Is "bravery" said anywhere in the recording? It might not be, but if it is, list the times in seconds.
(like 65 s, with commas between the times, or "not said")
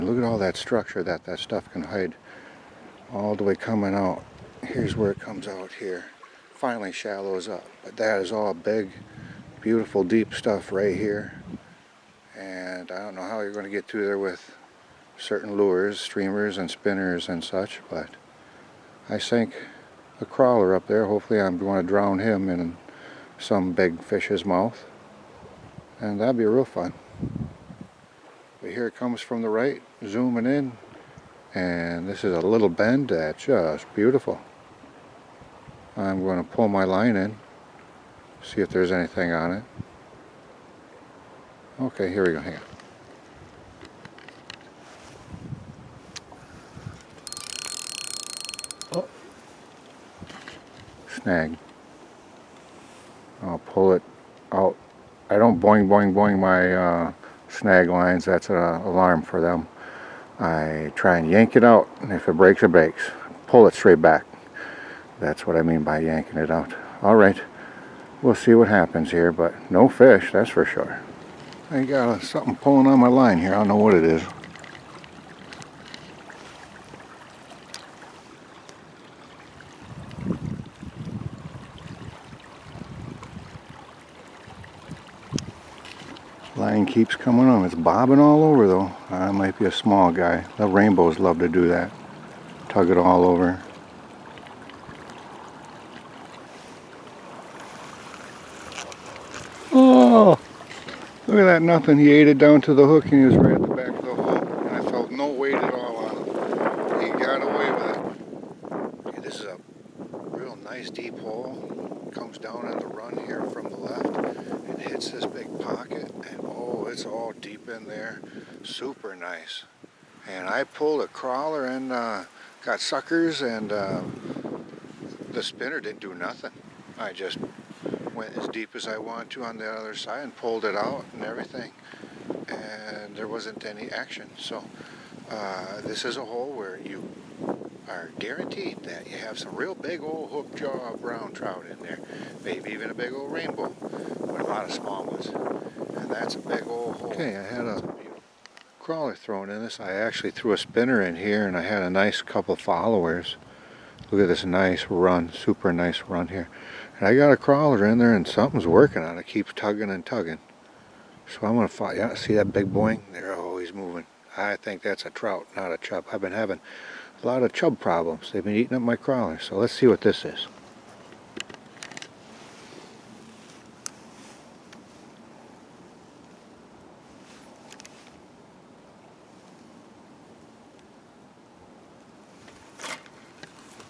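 not said.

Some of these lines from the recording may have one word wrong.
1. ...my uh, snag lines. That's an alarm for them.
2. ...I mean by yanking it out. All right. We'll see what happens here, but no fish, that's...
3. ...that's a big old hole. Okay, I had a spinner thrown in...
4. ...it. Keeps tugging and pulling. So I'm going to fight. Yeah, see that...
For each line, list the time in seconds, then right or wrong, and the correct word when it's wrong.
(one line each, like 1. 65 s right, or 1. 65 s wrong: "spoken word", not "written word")
1. 56 s right
2. 65 s right
3. 146 s wrong: "crawler", not "spinner"
4. 159 s wrong: "tugging", not "pulling".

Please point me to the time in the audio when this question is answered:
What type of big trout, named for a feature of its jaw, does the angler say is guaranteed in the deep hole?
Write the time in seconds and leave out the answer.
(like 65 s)
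140 s.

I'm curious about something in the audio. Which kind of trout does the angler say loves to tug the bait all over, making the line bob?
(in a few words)
rainbows.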